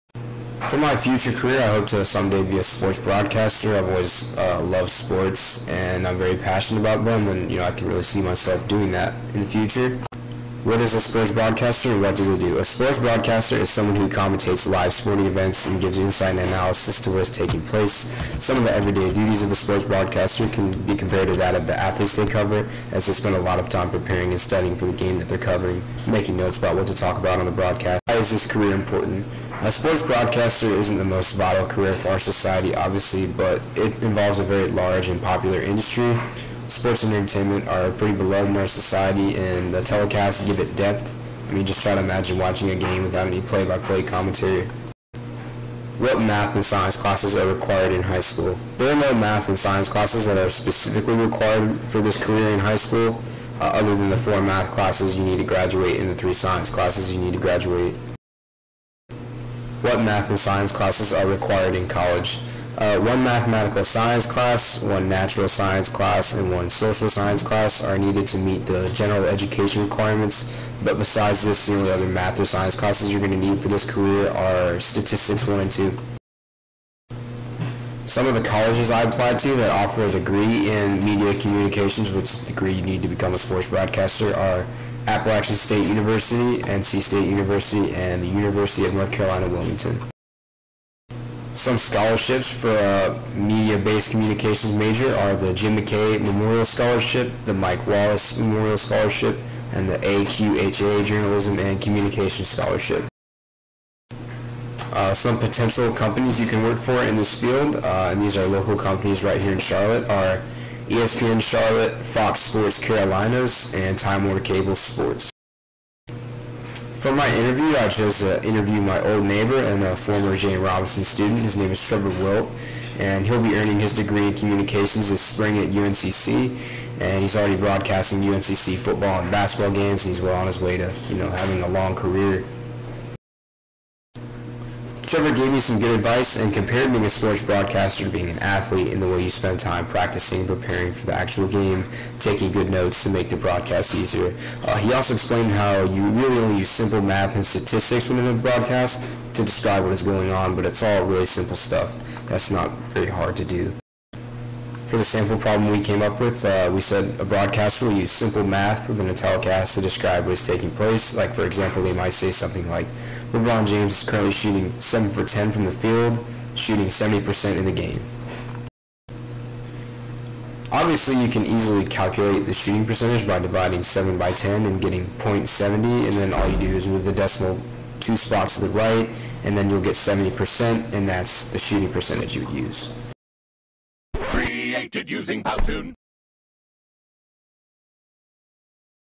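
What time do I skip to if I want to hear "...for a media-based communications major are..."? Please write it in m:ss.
1:32.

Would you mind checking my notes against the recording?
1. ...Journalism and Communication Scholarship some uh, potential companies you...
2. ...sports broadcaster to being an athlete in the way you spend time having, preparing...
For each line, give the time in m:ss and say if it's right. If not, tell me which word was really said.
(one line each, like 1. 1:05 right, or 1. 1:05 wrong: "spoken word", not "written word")
1. 1:41 right
2. 2:17 wrong: "practicing", not "having".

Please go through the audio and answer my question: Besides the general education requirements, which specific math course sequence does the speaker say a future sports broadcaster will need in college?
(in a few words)
statistics 1 and 2.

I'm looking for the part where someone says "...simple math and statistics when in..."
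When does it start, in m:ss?
2:26.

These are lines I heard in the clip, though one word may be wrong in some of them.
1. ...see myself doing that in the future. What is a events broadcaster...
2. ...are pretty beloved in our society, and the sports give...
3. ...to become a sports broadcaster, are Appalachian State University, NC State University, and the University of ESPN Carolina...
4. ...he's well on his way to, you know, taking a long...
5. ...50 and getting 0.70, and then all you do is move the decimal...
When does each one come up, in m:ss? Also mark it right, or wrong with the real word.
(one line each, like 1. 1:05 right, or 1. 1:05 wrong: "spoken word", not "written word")
1. 0:08 wrong: "sports", not "events"
2. 0:37 wrong: "telecasts", not "sports"
3. 1:23 wrong: "North", not "ESPN"
4. 2:10 wrong: "having", not "taking"
5. 2:54 wrong: "10", not "50".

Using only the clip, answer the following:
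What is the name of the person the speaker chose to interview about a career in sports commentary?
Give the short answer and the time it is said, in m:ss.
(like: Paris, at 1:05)
Trevor Wilt, at 2:01.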